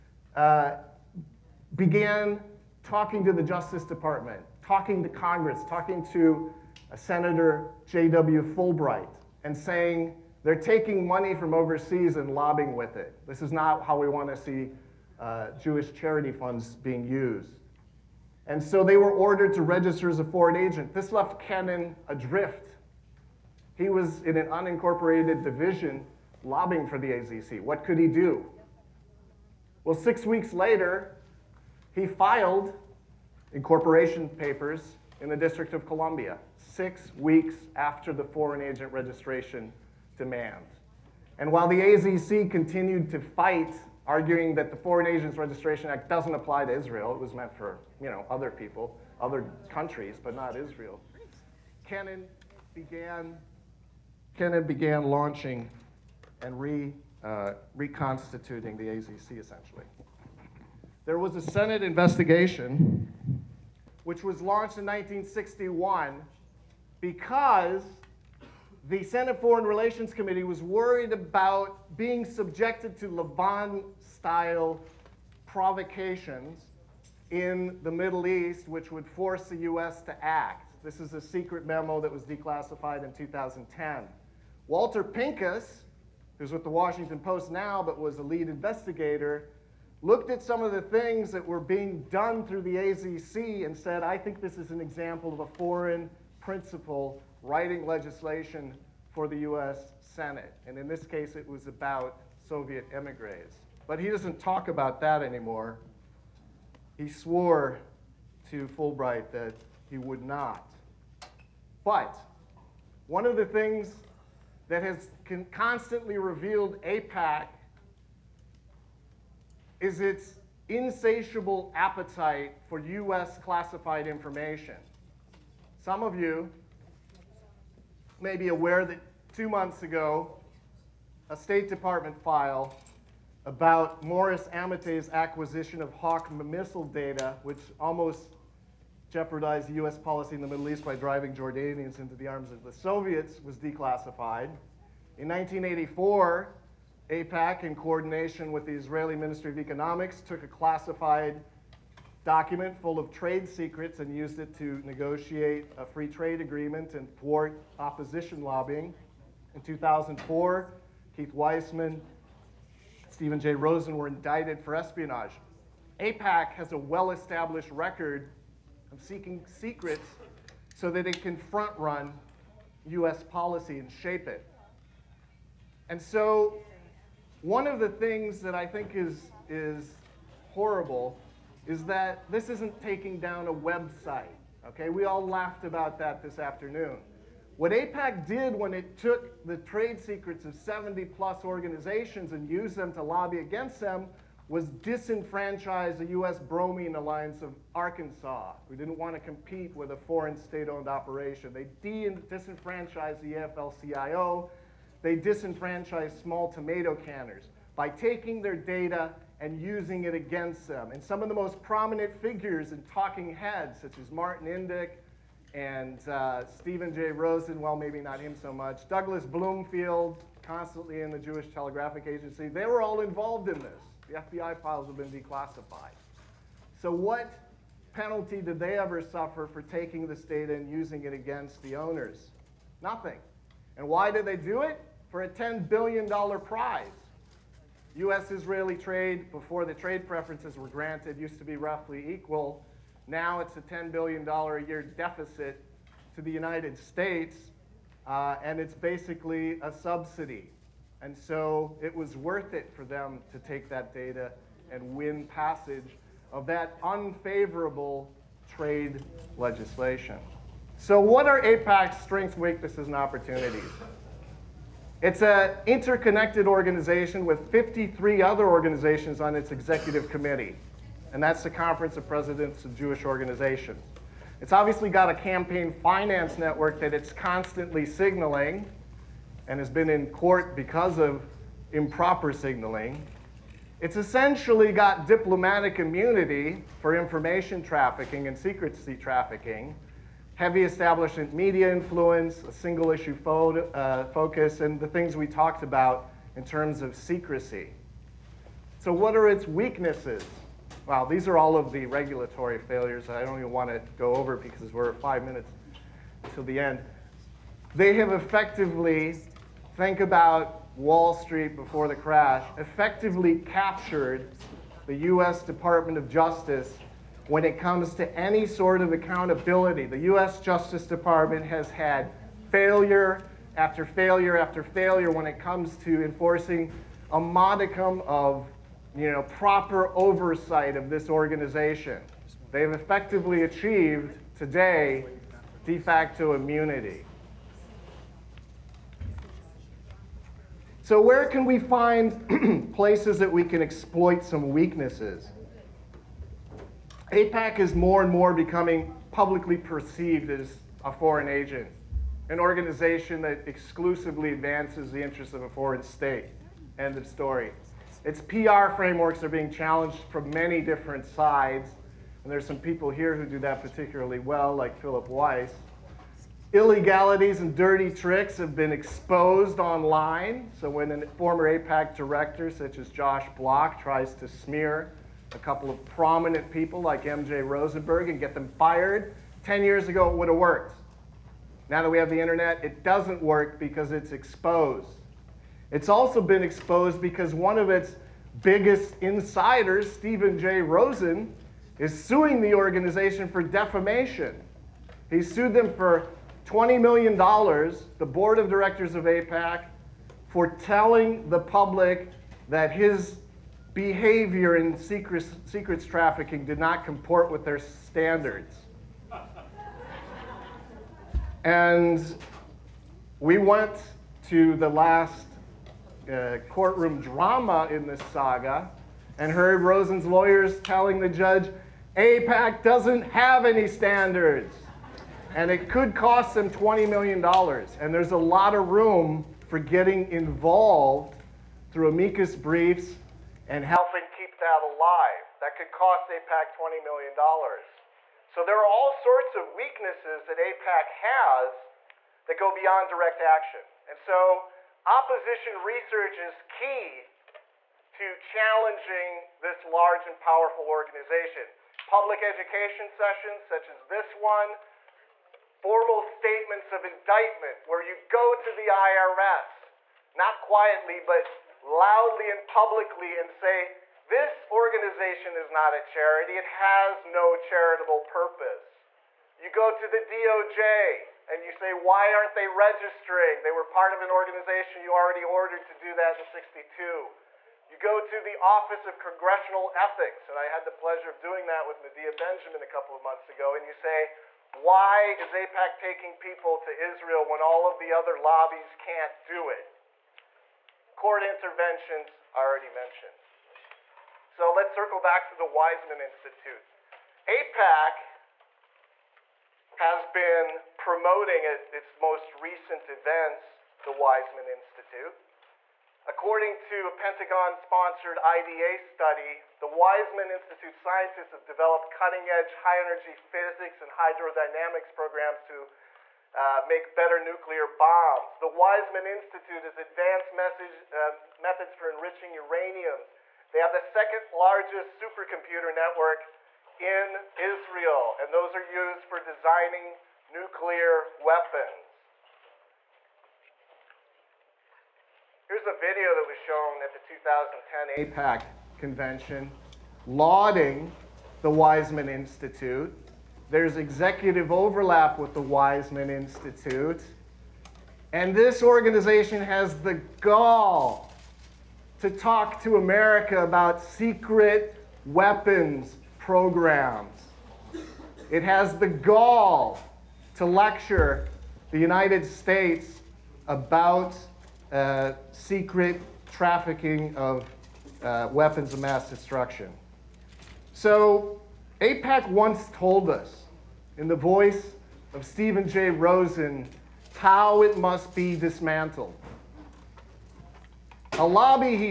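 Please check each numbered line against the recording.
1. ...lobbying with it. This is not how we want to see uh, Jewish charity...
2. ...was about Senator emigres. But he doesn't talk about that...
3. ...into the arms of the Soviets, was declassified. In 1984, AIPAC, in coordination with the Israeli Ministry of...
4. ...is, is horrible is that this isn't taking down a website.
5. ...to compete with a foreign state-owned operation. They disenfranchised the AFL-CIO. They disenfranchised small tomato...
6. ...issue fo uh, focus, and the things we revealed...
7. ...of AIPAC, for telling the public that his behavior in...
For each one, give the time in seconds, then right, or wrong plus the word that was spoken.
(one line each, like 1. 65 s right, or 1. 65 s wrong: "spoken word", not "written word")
1. 12 s right
2. 101 s wrong: "Soviet", not "Senator"
3. 141 s right
4. 178 s right
5. 199 s right
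6. 292 s wrong: "talked", not "revealed"
7. 398 s right.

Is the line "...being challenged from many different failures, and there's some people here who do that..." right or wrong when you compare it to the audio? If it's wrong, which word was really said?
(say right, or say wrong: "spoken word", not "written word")
wrong: "sides", not "failures".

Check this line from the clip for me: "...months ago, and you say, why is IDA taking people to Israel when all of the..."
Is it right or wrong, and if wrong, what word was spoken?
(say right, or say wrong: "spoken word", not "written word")
wrong: "AIPAC", not "IDA".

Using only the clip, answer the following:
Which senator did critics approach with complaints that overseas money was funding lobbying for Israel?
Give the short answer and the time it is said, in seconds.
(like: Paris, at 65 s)
J.W. Fulbright, at 6 s.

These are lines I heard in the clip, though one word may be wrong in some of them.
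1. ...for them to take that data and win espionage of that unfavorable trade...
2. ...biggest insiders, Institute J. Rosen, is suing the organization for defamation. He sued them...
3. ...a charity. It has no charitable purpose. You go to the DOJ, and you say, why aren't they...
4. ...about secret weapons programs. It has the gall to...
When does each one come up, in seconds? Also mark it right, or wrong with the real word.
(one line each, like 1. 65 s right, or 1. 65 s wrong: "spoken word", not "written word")
1. 252 s wrong: "passage", not "espionage"
2. 388 s wrong: "Stephen", not "Institute"
3. 465 s right
4. 553 s right.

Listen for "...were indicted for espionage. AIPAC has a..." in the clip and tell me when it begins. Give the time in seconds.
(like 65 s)
163 s.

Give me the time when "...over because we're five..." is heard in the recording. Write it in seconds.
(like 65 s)
304 s.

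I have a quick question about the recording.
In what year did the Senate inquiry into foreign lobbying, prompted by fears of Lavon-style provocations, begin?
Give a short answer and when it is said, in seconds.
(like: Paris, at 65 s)
1961, at 64 s.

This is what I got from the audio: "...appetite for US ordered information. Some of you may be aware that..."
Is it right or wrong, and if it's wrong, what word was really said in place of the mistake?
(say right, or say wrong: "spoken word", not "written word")
wrong: "classified", not "ordered".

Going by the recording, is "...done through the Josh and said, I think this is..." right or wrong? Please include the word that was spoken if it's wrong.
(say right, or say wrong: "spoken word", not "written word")
wrong: "AZC", not "Josh".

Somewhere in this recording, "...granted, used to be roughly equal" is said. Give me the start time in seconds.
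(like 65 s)
240 s.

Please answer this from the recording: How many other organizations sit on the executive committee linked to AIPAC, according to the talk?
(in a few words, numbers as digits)
53.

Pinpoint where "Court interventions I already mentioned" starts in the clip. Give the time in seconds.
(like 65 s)
490 s.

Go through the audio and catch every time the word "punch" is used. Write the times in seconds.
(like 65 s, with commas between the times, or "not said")
not said.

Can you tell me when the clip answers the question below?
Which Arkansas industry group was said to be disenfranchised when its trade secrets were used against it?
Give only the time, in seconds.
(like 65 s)
196 s.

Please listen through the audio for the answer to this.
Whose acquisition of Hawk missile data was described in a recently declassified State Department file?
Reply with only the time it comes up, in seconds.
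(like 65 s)
134 s.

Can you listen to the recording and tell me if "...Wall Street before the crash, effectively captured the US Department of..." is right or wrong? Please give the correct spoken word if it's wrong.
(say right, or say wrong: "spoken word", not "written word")
right.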